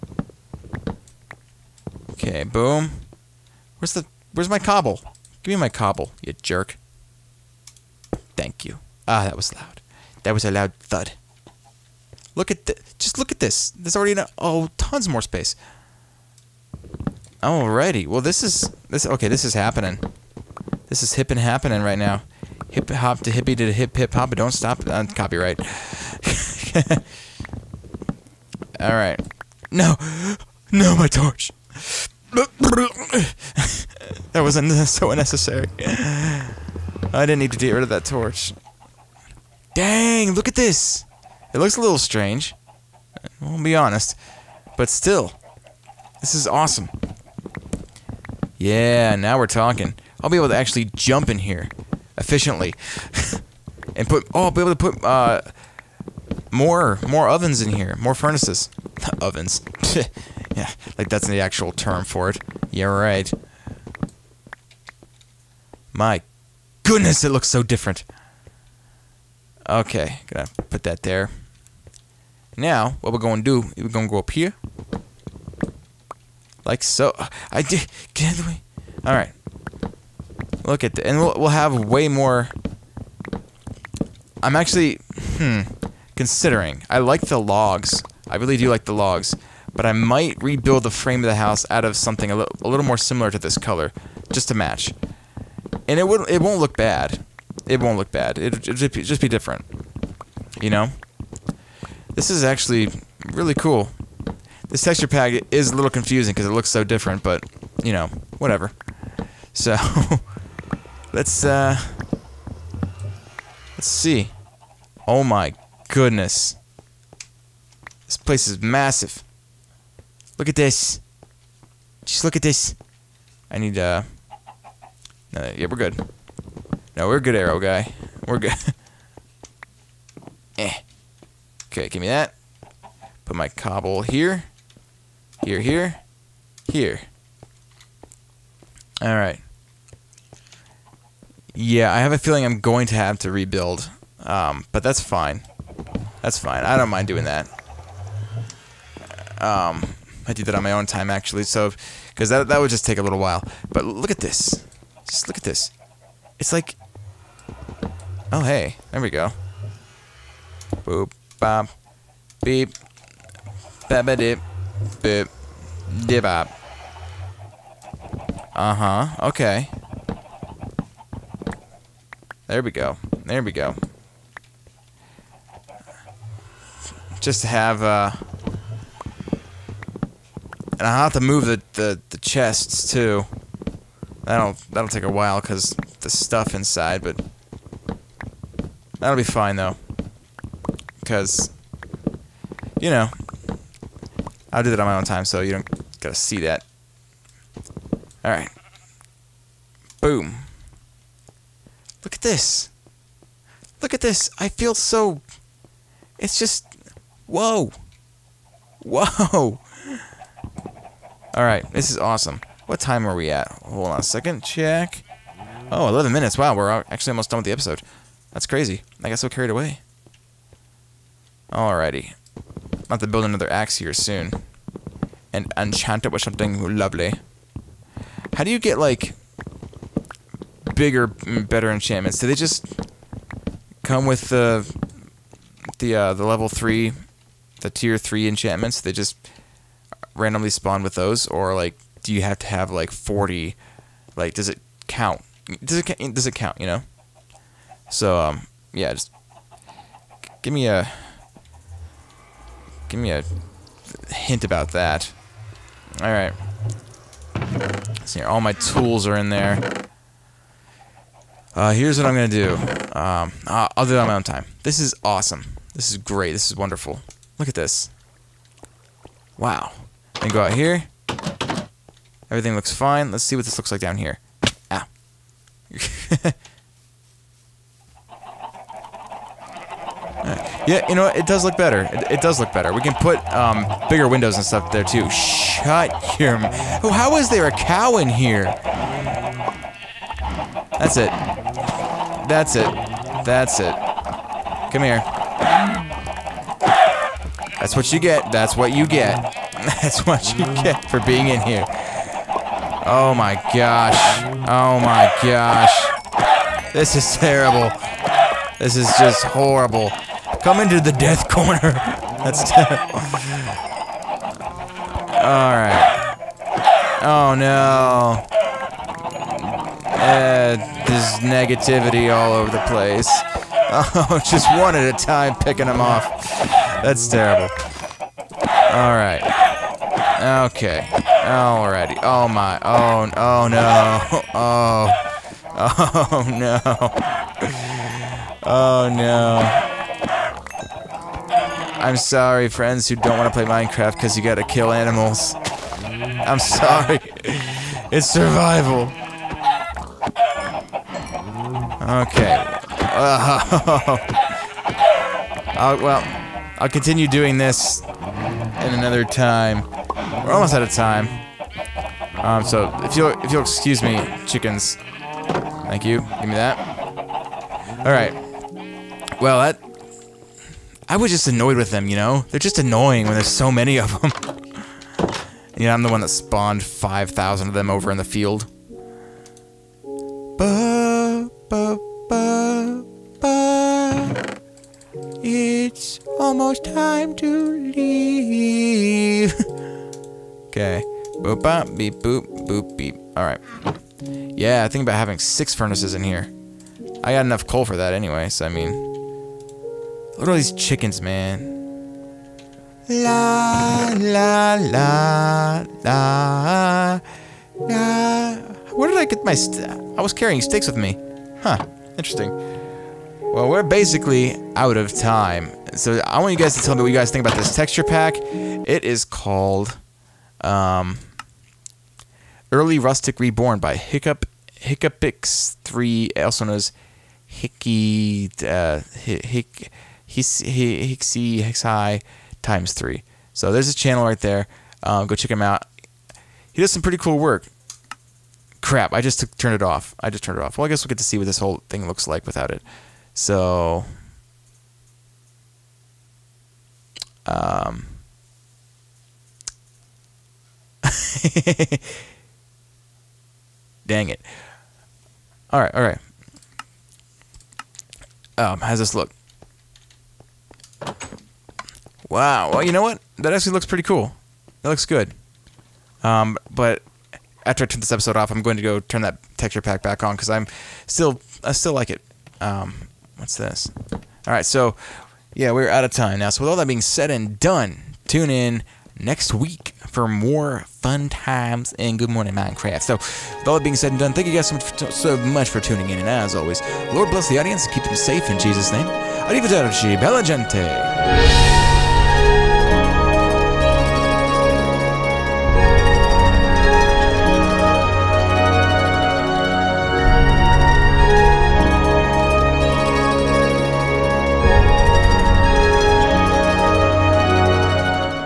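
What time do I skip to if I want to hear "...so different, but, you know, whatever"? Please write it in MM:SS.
01:46.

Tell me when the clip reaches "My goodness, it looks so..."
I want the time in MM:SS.
01:05.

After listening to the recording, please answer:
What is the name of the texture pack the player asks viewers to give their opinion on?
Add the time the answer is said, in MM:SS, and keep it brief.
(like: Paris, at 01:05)
Early Rustic Reborn, at 07:02.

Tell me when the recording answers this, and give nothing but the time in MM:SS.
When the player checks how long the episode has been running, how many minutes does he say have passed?
03:35.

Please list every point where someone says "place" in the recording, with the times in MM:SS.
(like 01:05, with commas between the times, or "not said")
01:58, 05:22.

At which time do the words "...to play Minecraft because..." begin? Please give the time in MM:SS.
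05:43.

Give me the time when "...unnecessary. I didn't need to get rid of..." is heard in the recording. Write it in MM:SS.
00:35.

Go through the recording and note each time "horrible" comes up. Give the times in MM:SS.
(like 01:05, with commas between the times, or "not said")
05:09.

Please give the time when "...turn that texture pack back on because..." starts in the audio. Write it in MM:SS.
07:48.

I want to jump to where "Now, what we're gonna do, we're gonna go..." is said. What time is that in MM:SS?
01:12.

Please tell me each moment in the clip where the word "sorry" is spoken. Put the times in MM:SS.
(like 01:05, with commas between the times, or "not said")
05:41, 05:46.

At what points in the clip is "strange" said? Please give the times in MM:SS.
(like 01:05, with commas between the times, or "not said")
00:41.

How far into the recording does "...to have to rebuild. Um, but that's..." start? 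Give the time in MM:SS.
02:22.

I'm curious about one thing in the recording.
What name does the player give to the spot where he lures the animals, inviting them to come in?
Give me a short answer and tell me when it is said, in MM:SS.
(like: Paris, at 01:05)
death corner, at 05:10.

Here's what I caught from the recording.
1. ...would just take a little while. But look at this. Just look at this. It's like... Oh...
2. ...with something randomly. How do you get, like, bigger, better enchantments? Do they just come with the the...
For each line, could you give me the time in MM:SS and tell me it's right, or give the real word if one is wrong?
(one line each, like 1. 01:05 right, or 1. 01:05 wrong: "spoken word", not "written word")
1. 02:32 right
2. 03:46 wrong: "lovely", not "randomly".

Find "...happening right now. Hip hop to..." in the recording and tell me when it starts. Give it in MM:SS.
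00:21.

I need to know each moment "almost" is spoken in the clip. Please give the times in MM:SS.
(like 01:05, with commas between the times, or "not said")
03:37, 06:00, 06:26.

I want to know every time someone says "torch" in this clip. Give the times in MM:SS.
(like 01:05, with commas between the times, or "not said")
00:31, 00:38.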